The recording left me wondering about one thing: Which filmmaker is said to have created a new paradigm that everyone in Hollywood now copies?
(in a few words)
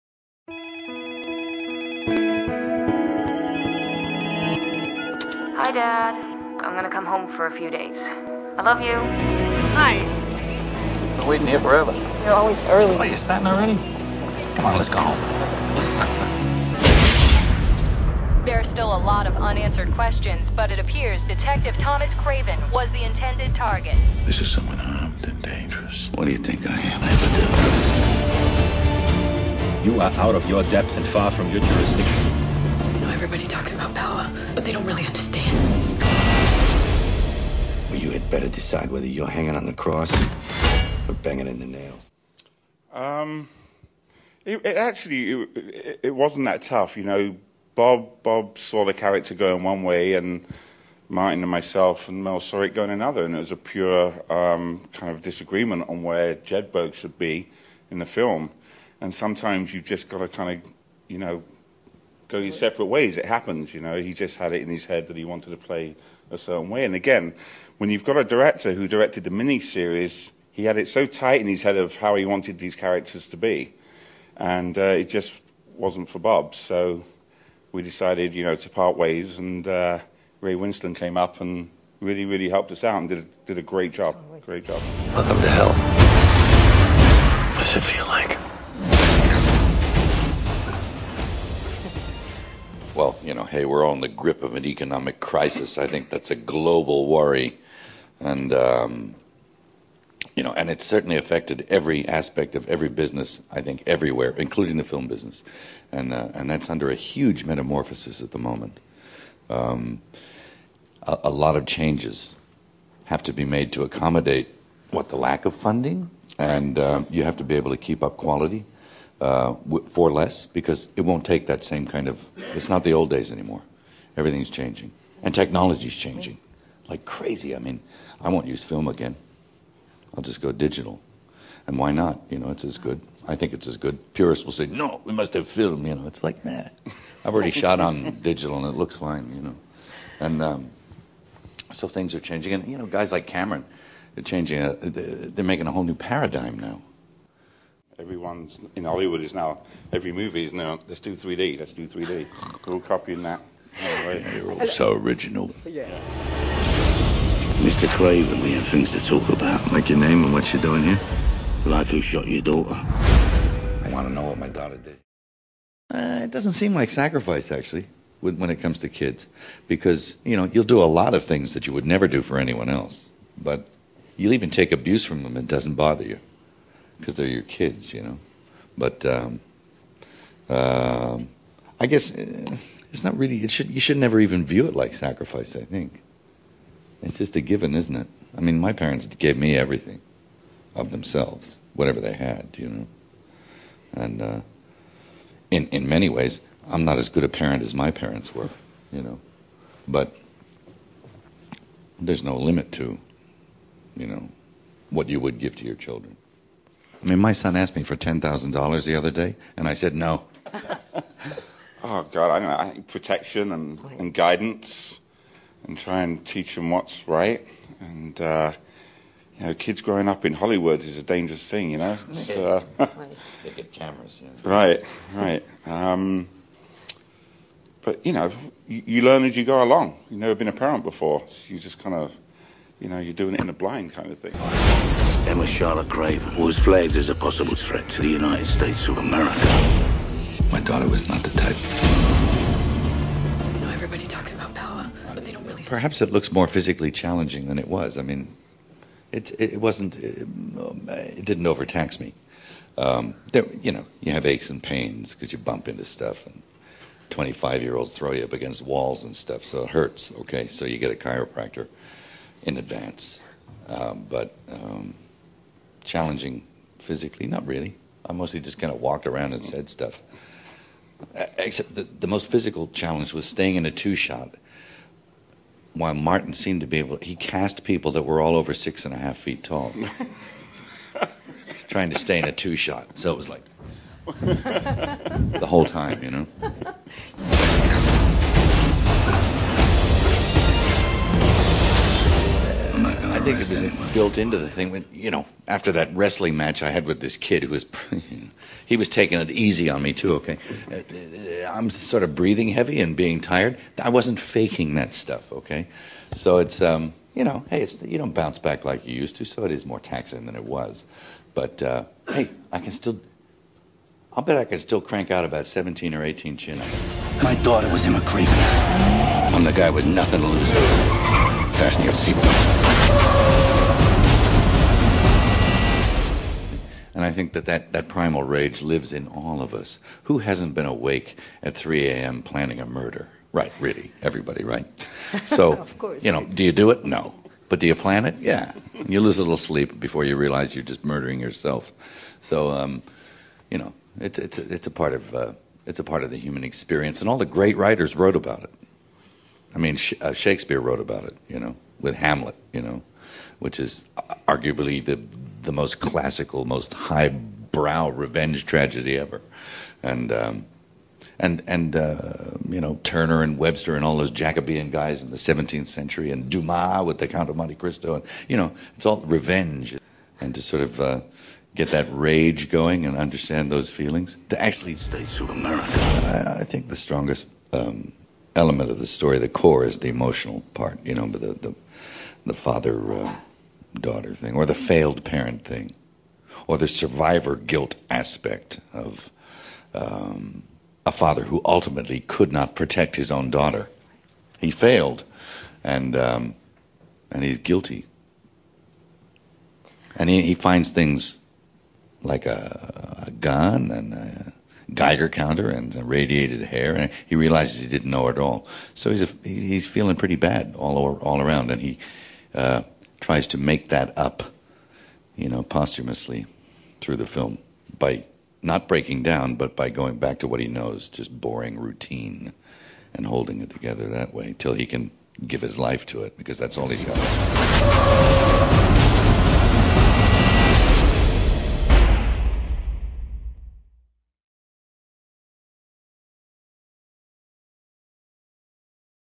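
Cameron.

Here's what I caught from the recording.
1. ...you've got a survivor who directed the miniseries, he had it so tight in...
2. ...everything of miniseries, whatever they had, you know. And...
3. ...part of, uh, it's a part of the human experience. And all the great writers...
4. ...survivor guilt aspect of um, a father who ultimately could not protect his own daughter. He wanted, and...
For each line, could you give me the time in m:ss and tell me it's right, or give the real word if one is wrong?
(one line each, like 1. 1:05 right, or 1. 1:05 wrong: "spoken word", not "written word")
1. 1:07 wrong: "director", not "survivor"
2. 3:09 wrong: "themselves", not "miniseries"
3. 5:44 right
4. 6:26 wrong: "failed", not "wanted".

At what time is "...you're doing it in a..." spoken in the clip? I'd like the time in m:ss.
3:52.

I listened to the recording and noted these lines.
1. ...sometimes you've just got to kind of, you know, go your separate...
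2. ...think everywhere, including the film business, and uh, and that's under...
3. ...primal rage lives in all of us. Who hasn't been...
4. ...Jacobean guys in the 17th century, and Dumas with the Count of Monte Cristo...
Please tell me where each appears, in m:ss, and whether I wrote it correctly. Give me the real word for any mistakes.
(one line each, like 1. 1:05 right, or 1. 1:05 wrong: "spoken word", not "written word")
1. 0:59 right
2. 1:43 right
3. 5:27 right
4. 6:04 right.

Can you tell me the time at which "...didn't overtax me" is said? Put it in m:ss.
4:11.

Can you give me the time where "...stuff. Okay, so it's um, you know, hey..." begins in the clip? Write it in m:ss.
5:04.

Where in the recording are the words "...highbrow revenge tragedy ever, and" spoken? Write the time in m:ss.
5:56.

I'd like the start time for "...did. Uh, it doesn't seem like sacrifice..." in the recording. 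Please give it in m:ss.
2:44.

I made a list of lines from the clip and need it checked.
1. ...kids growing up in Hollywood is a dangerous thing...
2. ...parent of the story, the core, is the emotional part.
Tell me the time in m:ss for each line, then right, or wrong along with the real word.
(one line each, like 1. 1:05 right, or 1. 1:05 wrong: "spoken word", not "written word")
1. 3:39 right
2. 6:18 wrong: "element", not "parent".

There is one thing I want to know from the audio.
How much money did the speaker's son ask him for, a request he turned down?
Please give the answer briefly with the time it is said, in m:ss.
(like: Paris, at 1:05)
$10,000, at 3:27.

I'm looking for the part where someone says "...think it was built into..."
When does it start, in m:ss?
4:53.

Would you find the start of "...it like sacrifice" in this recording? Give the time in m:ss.
3:04.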